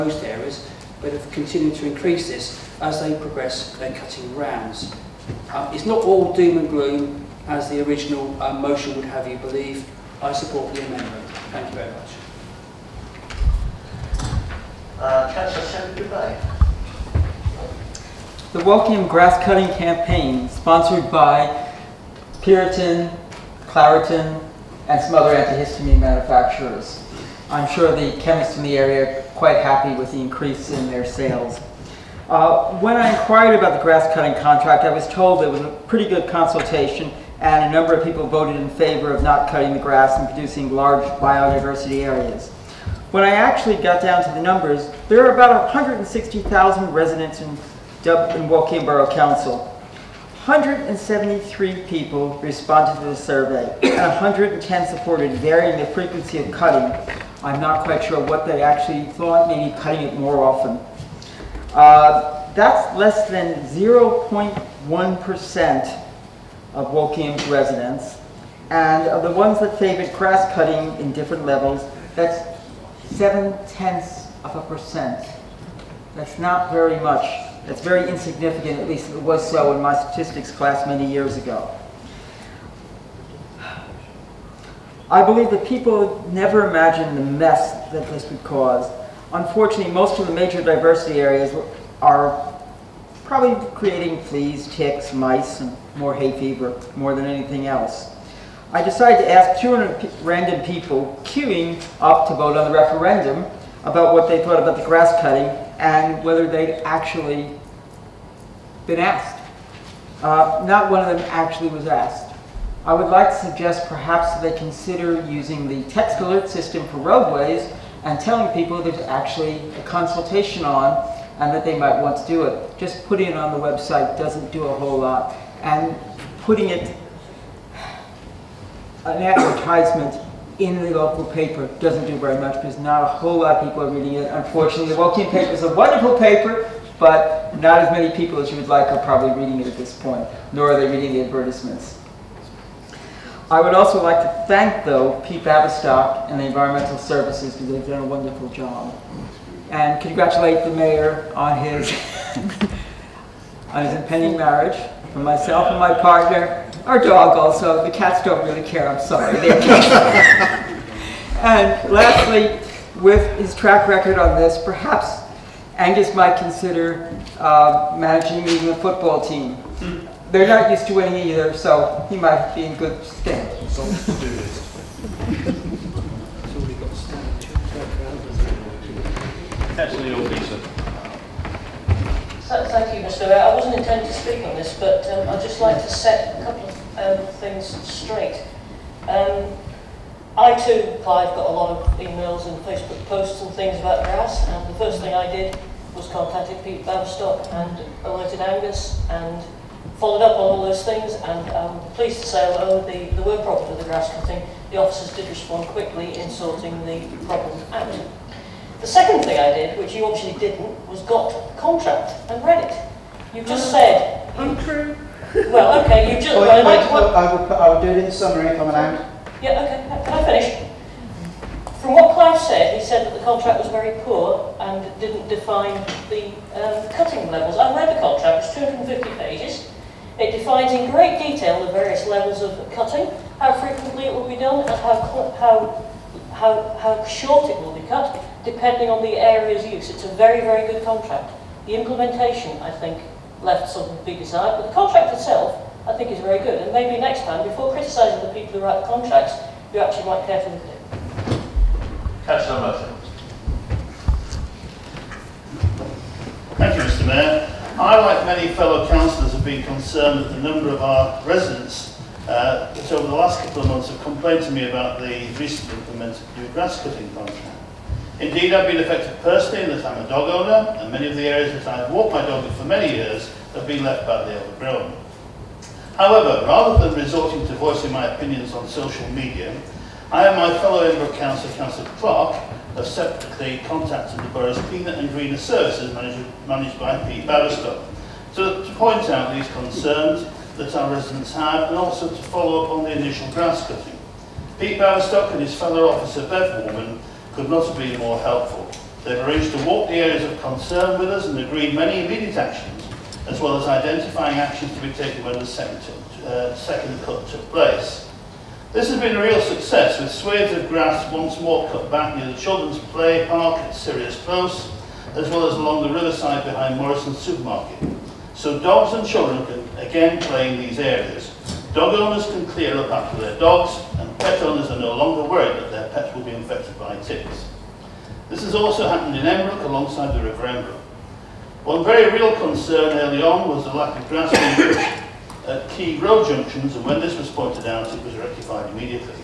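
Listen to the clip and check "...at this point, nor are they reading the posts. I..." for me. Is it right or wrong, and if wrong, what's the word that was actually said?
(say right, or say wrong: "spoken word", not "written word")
wrong: "advertisements", not "posts".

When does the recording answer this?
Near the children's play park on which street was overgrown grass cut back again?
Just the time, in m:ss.
5:13.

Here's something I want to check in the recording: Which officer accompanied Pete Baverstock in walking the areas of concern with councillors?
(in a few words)
Bev Warman.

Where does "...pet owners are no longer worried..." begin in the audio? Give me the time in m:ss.
5:24.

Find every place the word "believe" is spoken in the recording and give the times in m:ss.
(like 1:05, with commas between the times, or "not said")
0:09, 1:25.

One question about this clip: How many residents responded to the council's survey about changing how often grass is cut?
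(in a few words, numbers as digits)
173.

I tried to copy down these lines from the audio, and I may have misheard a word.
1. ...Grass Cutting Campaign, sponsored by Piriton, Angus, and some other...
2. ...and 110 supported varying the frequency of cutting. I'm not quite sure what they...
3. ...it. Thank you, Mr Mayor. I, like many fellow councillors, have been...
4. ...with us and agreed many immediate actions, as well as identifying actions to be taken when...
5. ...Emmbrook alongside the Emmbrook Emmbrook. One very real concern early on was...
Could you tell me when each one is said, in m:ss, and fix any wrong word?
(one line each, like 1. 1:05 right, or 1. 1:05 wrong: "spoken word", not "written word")
1. 0:19 wrong: "Claritin", not "Angus"
2. 0:53 right
3. 4:12 right
4. 5:00 right
5. 5:29 wrong: "River", not "Emmbrook".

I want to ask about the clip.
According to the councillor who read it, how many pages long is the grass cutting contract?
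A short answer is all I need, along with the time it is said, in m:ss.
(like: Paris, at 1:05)
250, at 3:48.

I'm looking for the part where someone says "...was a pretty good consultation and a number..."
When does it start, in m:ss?
0:35.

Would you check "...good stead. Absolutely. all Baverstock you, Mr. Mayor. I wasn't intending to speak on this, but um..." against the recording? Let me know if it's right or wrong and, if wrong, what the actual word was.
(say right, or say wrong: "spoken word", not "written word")
wrong: "Thank", not "Baverstock".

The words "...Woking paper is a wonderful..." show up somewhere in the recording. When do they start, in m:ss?
2:14.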